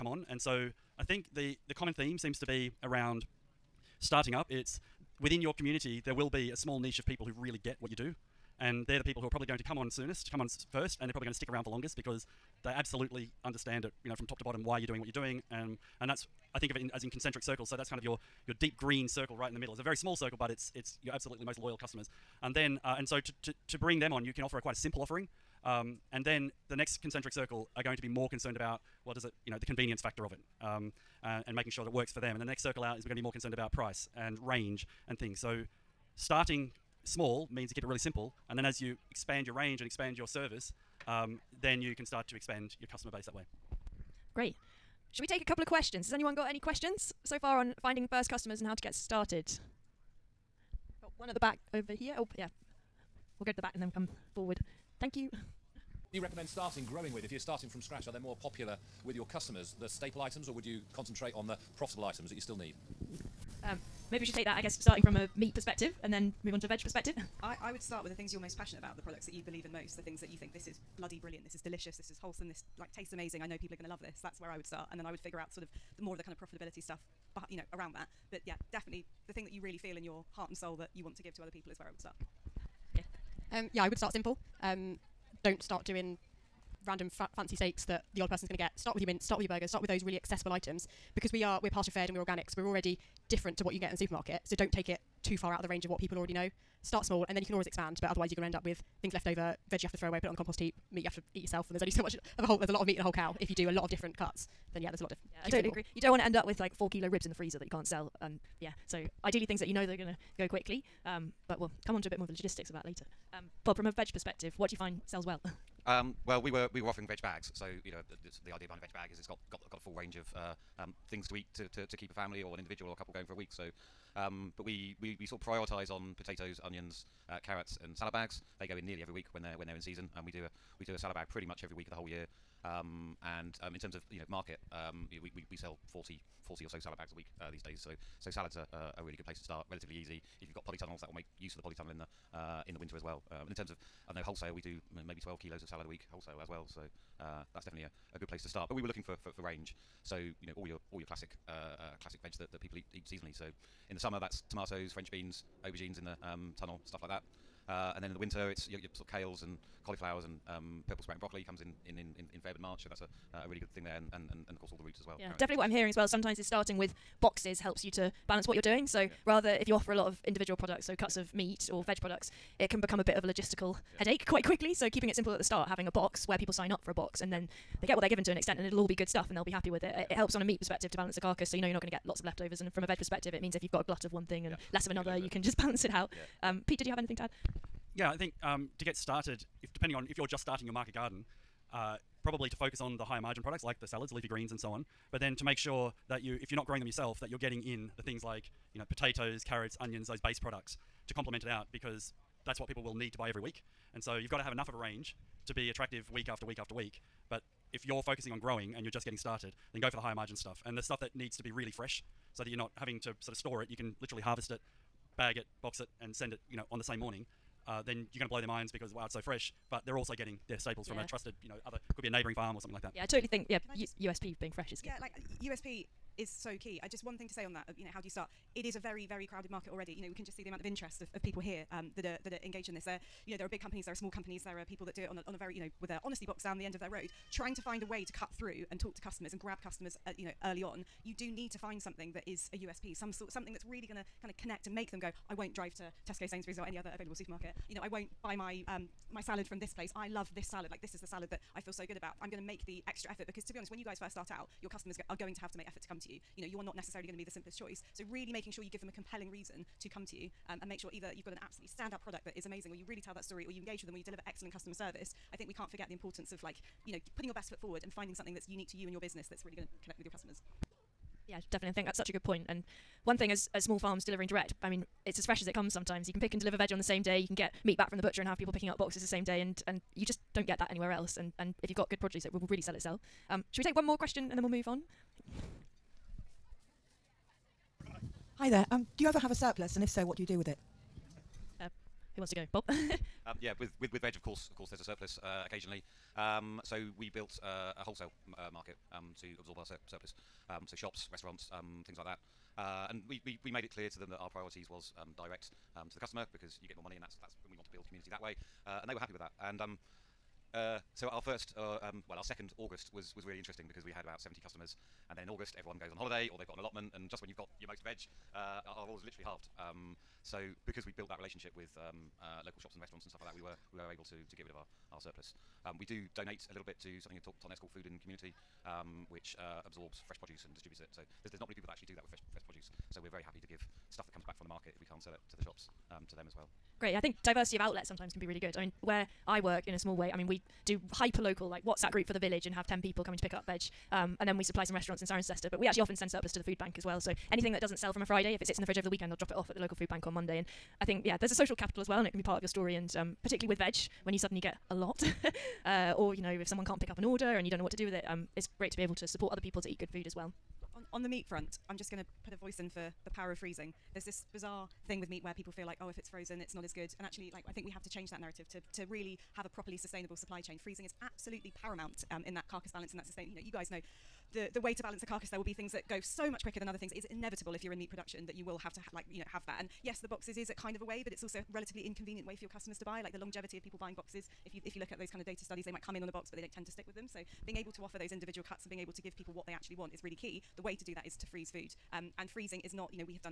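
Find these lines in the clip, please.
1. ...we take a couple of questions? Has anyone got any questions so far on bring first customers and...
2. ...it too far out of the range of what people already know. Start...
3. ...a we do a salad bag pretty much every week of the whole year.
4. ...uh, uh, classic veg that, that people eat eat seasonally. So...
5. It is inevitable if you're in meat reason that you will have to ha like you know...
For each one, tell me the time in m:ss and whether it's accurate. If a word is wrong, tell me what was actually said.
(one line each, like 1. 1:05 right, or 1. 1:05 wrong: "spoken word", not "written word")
1. 0:45 wrong: "finding", not "bring"
2. 1:34 right
3. 2:10 right
4. 2:31 right
5. 6:16 wrong: "production", not "reason".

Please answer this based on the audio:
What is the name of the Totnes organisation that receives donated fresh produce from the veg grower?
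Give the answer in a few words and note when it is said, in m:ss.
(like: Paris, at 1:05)
Food and Community, at 5:27.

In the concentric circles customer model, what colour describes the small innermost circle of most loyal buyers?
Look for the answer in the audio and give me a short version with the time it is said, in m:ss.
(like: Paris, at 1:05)
deep green, at 0:18.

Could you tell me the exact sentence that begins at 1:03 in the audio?
Um, maybe we should take that, I guess, starting from a meat perspective and then move on to a veg perspective.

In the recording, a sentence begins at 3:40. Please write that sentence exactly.
from a trusted, you know, other could be a neighbouring farm or something like that.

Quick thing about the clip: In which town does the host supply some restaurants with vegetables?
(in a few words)
Cirencester.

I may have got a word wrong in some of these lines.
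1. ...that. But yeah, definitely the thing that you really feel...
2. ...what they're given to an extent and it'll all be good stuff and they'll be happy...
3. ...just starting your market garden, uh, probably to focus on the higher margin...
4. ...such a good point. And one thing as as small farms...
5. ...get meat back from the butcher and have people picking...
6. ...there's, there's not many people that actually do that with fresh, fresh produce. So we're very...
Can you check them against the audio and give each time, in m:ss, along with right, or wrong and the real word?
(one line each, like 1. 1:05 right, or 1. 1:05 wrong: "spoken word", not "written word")
1. 1:17 right
2. 2:57 right
3. 3:10 right
4. 4:31 right
5. 4:37 right
6. 5:31 right.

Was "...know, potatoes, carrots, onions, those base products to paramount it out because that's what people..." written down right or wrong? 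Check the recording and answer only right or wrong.
wrong.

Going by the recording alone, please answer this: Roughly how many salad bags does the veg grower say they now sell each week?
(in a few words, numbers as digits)
40.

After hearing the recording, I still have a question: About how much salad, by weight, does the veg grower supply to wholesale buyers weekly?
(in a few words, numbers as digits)
12 kilos.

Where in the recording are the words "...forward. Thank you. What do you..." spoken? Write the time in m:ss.
0:54.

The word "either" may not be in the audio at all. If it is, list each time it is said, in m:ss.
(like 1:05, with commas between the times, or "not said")
4:20.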